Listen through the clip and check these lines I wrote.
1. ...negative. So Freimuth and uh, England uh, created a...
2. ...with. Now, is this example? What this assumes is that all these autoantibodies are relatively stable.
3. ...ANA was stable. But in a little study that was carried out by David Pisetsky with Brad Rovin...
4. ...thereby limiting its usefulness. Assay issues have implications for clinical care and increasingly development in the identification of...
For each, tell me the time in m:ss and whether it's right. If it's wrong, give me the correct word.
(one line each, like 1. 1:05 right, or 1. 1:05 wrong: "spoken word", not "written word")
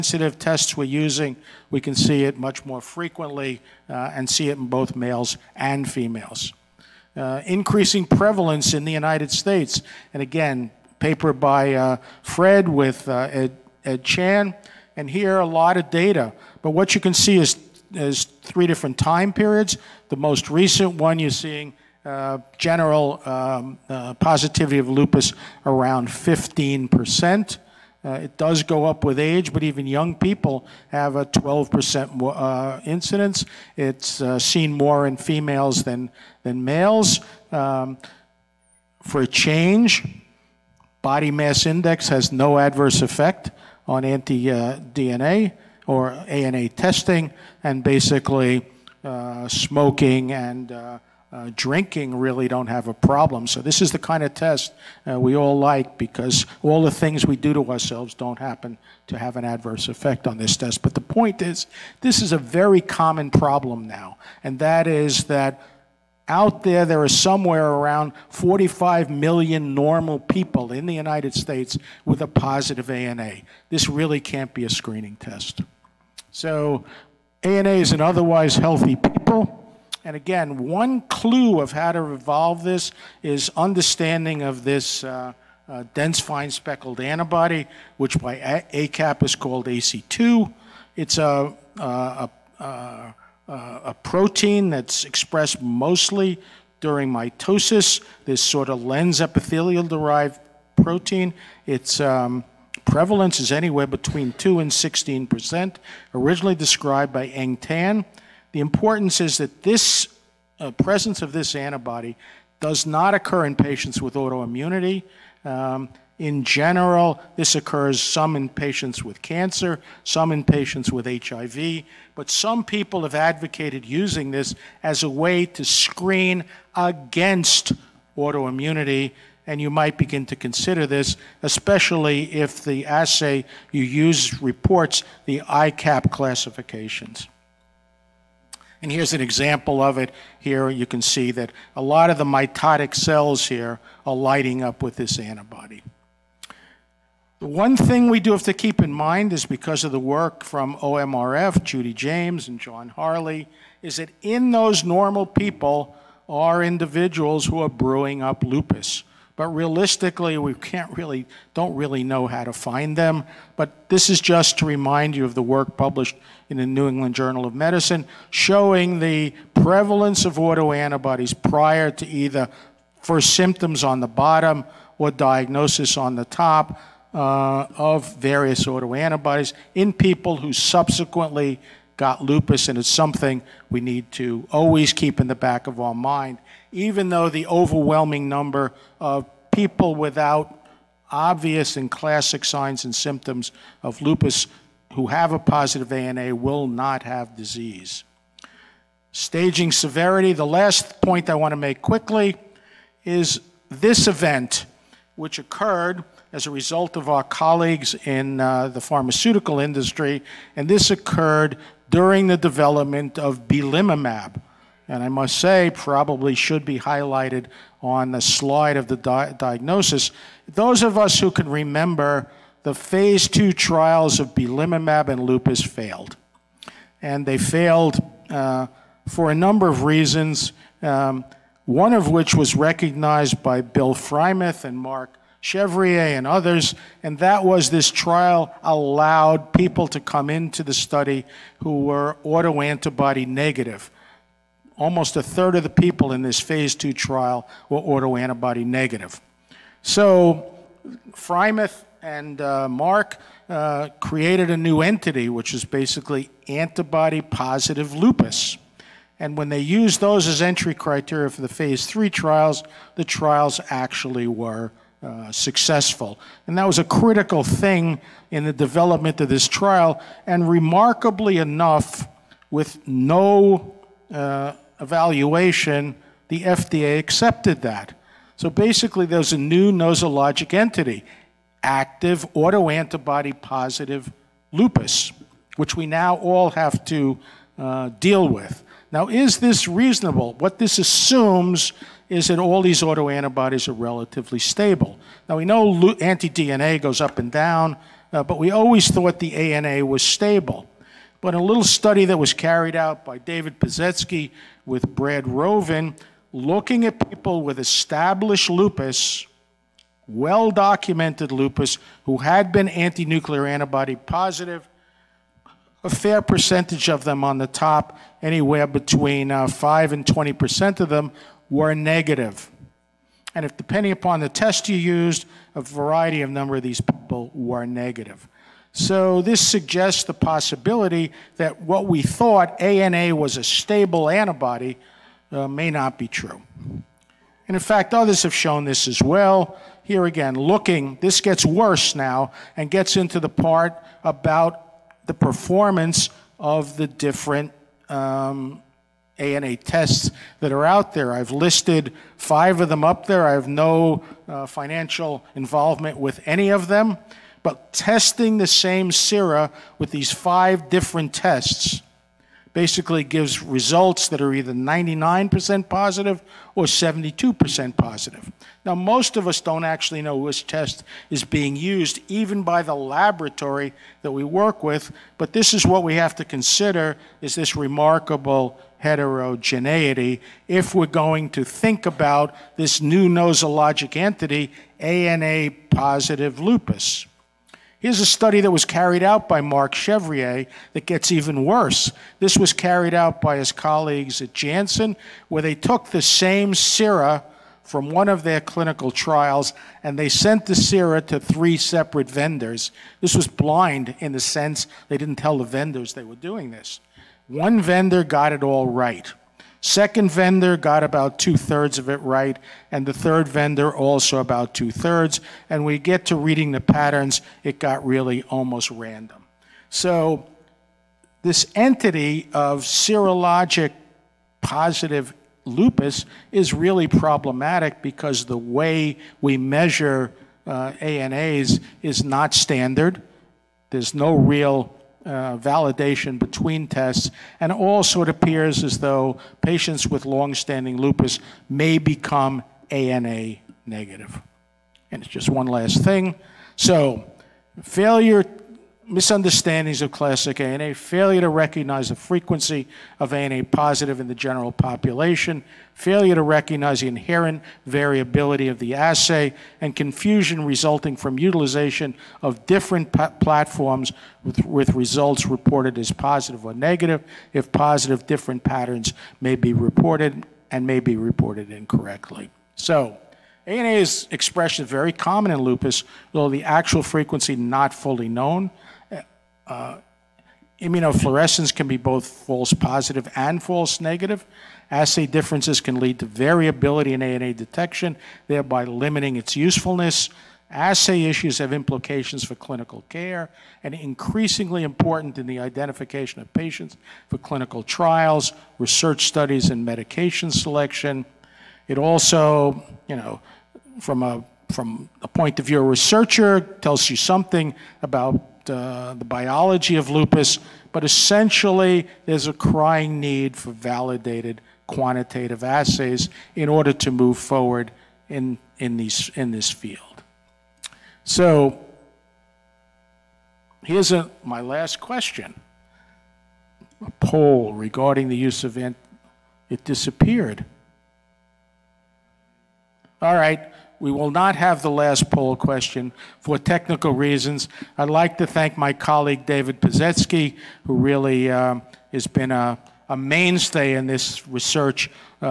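1. 4:08 wrong: "Mark", not "England"
2. 4:48 wrong: "reasonable", not "example"
3. 4:59 right
4. 8:08 wrong: "important", not "development".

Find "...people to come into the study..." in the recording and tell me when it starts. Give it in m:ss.
3:59.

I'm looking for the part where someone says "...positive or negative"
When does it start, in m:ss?
7:45.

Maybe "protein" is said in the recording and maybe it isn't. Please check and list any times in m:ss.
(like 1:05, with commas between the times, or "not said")
1:34, 1:40.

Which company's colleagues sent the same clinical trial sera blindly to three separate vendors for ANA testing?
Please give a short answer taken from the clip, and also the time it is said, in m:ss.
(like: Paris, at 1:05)
Janssen, at 6:34.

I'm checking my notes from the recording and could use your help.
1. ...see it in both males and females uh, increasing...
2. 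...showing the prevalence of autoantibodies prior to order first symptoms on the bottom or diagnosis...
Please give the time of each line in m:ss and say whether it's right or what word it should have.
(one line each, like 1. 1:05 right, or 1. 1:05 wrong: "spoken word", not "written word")
1. 0:04 right
2. 2:48 wrong: "either", not "order".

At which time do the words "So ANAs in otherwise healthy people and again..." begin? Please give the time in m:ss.
1:16.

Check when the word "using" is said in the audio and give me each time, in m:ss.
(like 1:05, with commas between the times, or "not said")
0:00, 2:03.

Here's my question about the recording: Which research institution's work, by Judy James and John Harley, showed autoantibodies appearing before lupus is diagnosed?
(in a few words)
OMRF.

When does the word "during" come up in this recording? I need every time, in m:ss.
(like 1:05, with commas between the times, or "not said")
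1:36, 3:31.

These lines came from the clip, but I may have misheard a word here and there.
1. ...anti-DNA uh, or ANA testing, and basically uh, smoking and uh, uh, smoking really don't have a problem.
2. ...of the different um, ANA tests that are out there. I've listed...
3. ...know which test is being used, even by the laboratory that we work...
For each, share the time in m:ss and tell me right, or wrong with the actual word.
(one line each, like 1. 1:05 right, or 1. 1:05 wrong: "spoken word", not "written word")
1. 0:44 wrong: "drinking", not "smoking"
2. 5:46 right
3. 6:10 right.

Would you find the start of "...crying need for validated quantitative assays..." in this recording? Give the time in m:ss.
8:32.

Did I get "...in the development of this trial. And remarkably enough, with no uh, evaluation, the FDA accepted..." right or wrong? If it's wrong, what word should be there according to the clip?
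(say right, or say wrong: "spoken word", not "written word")
right.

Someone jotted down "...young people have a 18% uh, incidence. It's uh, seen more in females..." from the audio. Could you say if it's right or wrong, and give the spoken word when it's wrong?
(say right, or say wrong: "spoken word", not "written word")
wrong: "12", not "18".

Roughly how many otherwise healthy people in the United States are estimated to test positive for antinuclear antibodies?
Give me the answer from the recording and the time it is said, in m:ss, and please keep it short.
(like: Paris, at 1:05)
45 million, at 1:08.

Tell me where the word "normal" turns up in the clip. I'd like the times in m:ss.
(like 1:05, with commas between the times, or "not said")
1:09, 2:34.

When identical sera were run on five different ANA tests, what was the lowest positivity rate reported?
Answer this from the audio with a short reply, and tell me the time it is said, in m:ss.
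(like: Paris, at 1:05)
72%, at 6:06.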